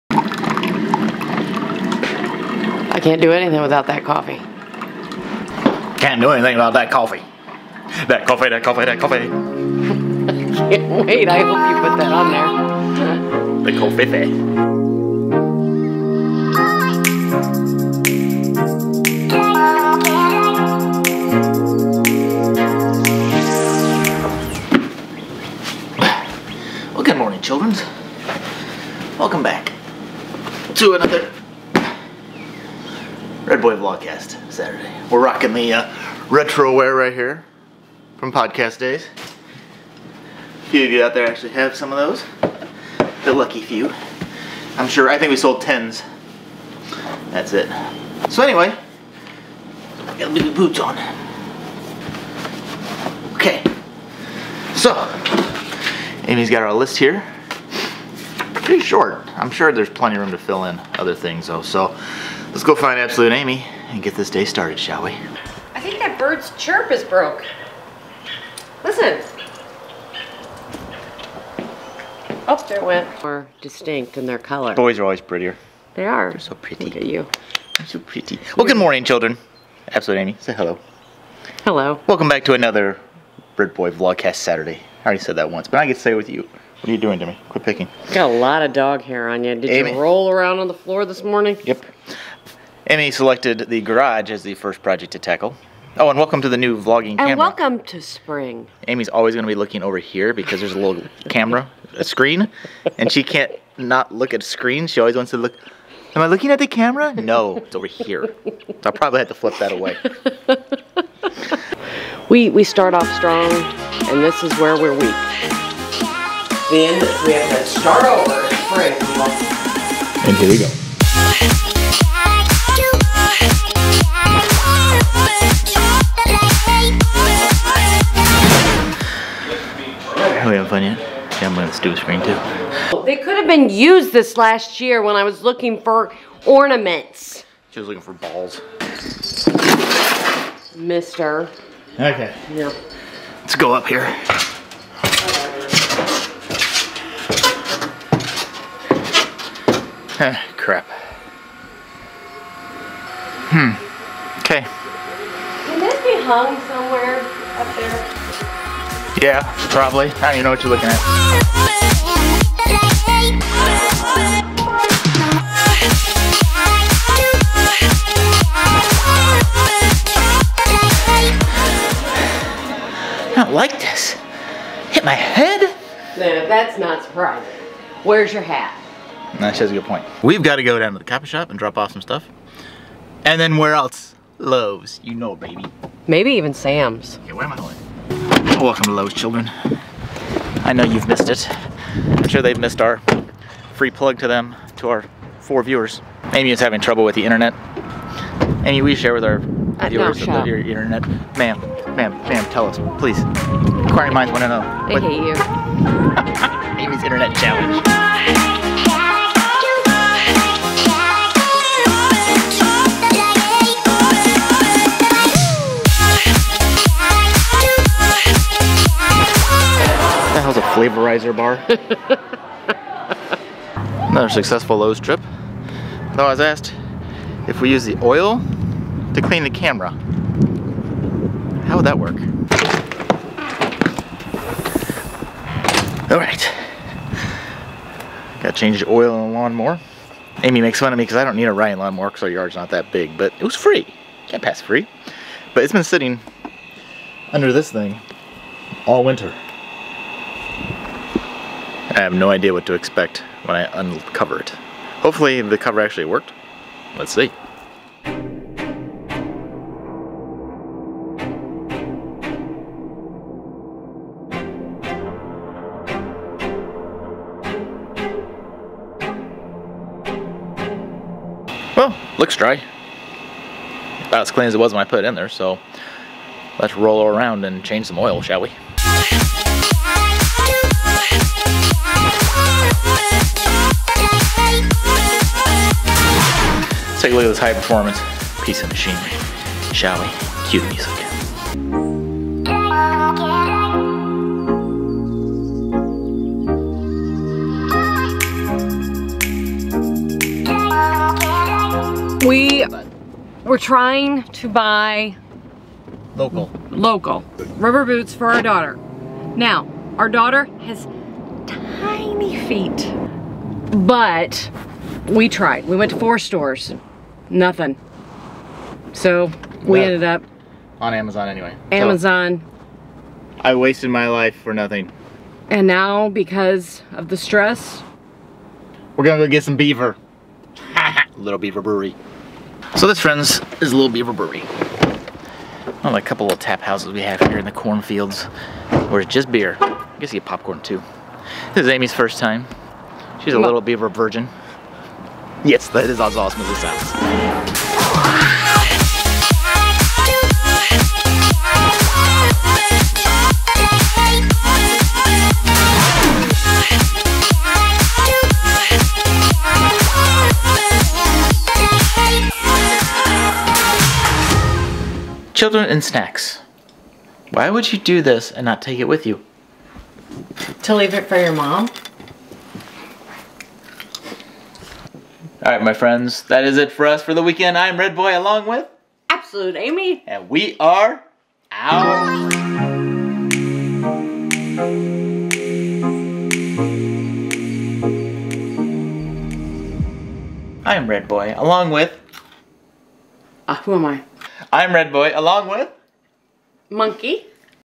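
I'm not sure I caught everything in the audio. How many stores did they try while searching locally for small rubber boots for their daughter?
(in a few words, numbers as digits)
4.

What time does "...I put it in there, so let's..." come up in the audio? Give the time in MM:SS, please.
04:34.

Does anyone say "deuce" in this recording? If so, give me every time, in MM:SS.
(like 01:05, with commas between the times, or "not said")
not said.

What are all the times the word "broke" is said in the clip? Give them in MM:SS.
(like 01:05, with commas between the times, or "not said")
01:07.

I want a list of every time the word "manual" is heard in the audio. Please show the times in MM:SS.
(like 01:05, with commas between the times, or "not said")
not said.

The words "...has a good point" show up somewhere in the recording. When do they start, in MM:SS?
02:59.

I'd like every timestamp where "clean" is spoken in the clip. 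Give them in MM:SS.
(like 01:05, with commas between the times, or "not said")
03:49, 04:34.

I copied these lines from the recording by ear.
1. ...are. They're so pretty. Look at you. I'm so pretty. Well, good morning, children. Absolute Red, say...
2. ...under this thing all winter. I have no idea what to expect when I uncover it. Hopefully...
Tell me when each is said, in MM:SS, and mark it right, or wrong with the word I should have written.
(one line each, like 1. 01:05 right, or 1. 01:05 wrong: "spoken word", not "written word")
1. 01:16 wrong: "Amy", not "Red"
2. 04:07 right.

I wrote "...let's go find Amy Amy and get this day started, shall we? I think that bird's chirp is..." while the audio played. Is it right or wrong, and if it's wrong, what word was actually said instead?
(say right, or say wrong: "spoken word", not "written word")
wrong: "Absolute", not "Amy".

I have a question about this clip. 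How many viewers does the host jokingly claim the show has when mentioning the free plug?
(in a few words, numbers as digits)
4.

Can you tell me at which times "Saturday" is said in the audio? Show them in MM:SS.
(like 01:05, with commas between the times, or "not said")
00:34, 01:24.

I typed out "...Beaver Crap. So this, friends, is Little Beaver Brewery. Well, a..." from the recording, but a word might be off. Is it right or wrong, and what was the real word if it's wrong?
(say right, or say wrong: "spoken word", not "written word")
wrong: "Brewery", not "Crap".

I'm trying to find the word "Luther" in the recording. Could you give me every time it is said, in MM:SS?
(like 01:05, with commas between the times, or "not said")
not said.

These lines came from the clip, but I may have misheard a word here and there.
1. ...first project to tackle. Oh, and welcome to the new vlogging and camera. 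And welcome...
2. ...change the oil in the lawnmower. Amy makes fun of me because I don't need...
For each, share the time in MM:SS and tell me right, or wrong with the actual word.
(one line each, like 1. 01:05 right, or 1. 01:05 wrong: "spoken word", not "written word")
1. 01:34 right
2. 03:58 right.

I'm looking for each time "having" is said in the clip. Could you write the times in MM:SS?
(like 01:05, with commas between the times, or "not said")
02:10, 03:16.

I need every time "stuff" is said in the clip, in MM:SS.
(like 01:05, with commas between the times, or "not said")
03:02.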